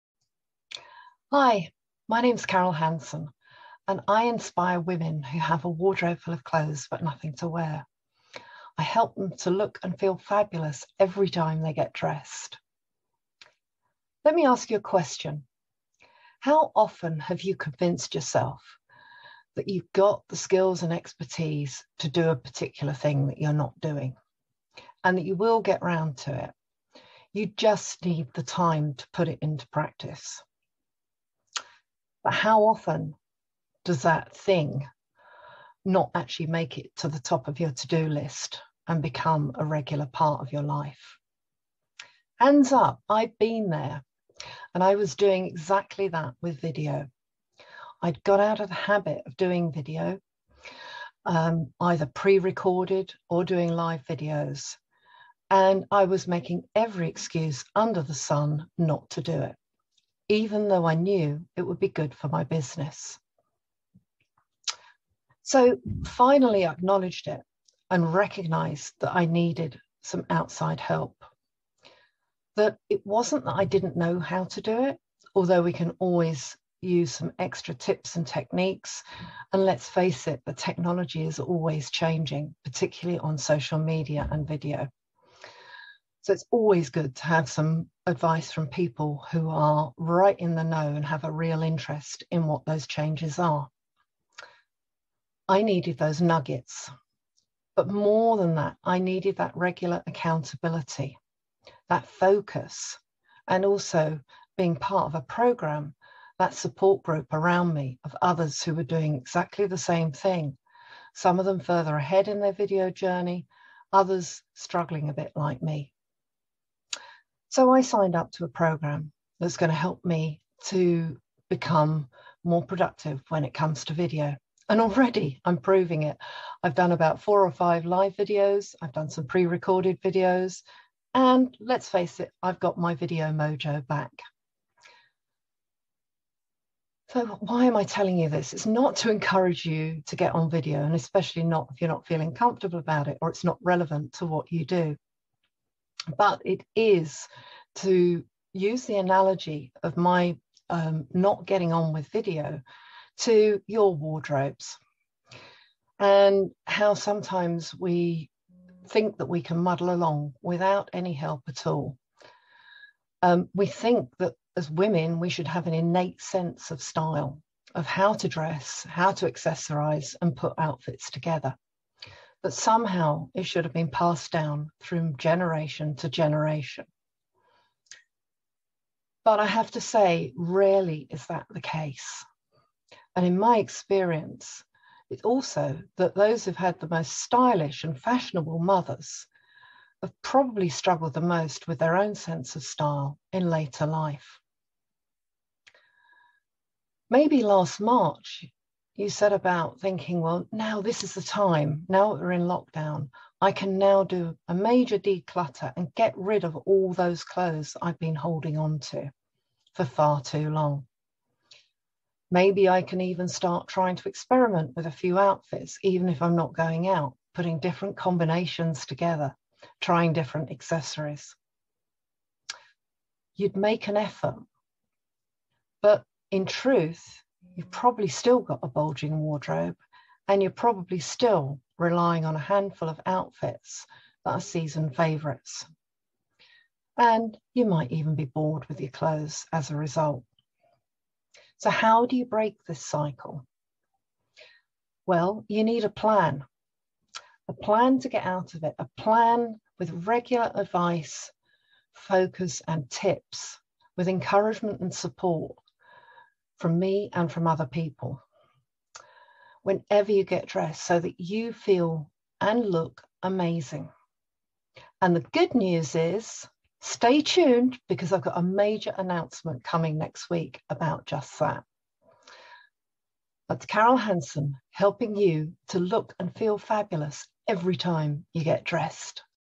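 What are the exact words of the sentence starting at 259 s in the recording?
Whenever you get dressed, so that you feel and look amazing.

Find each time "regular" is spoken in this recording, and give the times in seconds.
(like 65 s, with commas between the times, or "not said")
39 s, 99 s, 250 s.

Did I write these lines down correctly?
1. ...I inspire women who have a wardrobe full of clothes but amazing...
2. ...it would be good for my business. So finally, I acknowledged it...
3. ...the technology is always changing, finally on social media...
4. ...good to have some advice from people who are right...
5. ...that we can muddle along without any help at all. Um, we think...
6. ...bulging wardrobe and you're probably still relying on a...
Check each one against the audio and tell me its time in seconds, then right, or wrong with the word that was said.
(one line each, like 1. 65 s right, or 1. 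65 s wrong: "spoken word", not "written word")
1. 4 s wrong: "nothing", not "amazing"
2. 61 s right
3. 80 s wrong: "particularly", not "finally"
4. 86 s right
5. 159 s right
6. 228 s right.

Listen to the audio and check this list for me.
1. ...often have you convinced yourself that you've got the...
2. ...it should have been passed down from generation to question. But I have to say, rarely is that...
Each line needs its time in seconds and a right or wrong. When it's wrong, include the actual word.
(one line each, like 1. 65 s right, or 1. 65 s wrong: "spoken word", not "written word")
1. 16 s right
2. 173 s wrong: "generation", not "question".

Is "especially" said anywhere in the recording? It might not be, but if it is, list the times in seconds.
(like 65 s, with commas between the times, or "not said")
140 s.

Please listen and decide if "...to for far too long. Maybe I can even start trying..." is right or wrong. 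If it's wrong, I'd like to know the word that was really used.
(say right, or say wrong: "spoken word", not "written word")
right.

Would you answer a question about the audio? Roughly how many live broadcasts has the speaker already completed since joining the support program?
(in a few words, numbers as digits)
4 or 5.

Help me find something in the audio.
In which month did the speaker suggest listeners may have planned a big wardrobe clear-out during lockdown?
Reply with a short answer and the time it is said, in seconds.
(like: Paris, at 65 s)
March, at 197 s.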